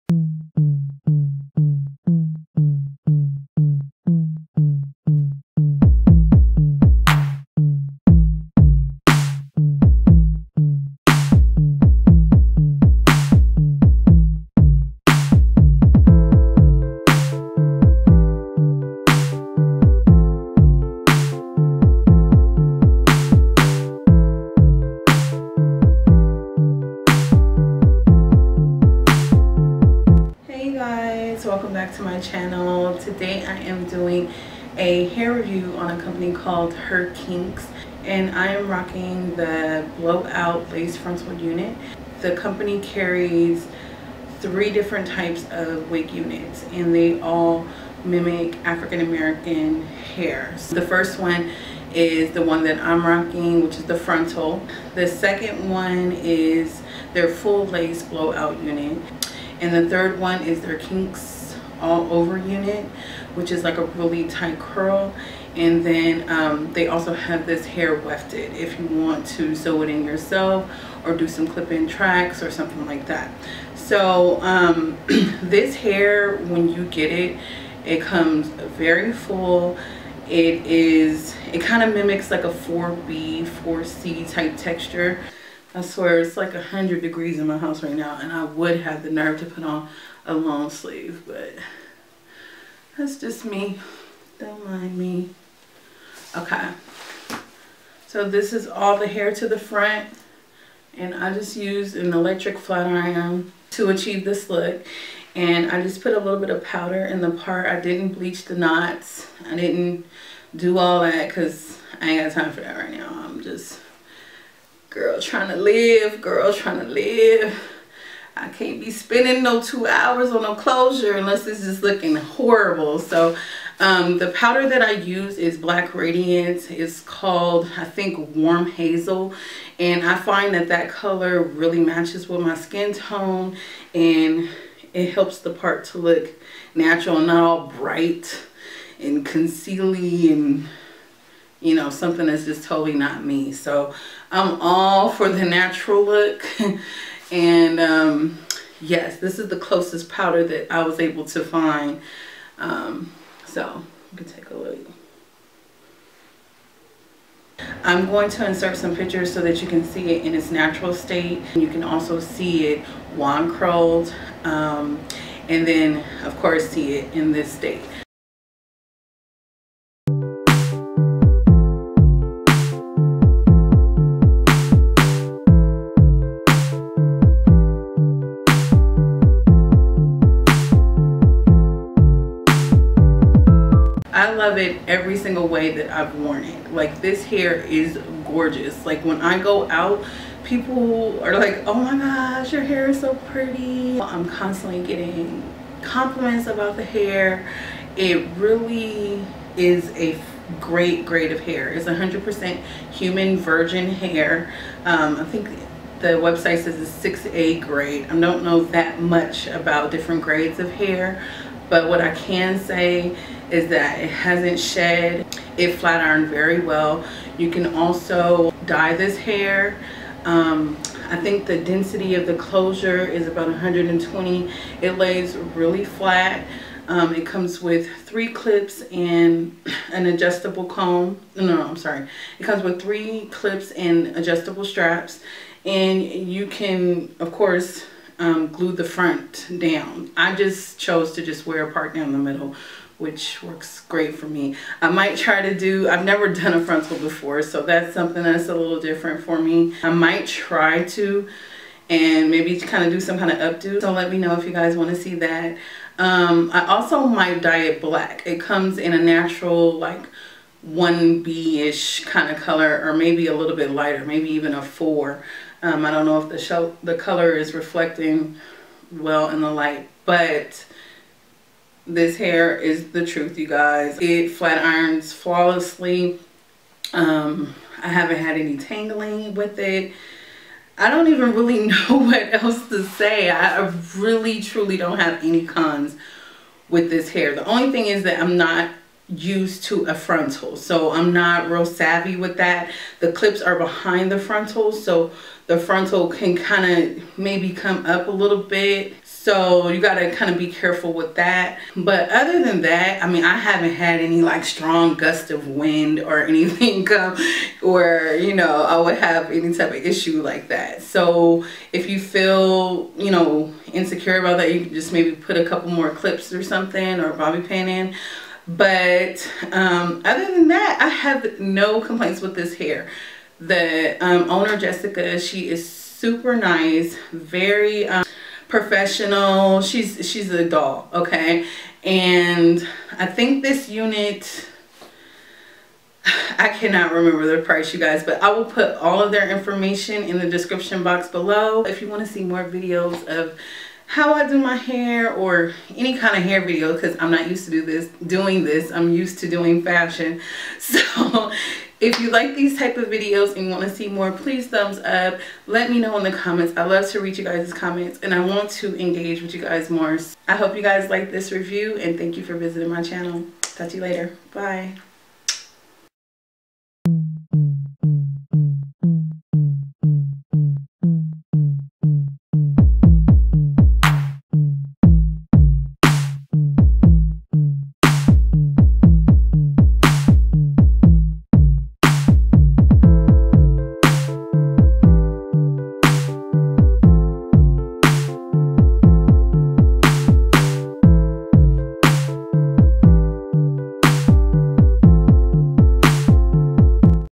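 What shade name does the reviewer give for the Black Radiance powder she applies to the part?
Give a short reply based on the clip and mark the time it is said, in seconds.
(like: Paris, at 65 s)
Warm Hazel, at 128 s.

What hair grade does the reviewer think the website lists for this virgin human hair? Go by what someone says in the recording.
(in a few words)
6A.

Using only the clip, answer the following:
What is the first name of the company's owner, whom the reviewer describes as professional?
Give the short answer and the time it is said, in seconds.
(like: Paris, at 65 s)
Jessica, at 324 s.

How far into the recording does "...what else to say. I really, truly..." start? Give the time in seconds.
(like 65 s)
281 s.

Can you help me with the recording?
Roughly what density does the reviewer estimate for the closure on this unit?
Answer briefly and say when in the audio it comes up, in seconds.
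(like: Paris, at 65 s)
120, at 223 s.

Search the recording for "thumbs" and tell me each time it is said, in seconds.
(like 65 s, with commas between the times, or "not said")
354 s.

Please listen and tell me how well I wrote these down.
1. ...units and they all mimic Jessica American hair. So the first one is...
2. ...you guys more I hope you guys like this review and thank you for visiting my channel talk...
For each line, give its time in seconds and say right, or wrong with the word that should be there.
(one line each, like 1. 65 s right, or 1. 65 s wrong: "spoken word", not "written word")
1. 46 s wrong: "African", not "Jessica"
2. 359 s right.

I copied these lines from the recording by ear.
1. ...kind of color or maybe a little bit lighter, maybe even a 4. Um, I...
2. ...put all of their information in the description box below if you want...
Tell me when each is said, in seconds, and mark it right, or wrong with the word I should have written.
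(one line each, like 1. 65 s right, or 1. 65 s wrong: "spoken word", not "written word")
1. 262 s right
2. 338 s right.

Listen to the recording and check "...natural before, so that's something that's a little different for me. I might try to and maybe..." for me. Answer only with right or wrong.
wrong.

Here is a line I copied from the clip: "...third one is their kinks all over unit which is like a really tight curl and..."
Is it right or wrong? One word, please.
right.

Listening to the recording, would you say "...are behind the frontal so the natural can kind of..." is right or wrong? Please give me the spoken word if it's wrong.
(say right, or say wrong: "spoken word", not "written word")
wrong: "frontal", not "natural".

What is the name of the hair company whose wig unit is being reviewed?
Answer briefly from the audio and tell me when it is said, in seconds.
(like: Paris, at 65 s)
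Her Kinkz, at 36 s.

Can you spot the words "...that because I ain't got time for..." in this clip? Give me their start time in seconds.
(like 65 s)
110 s.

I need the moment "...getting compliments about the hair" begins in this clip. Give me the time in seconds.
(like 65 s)
194 s.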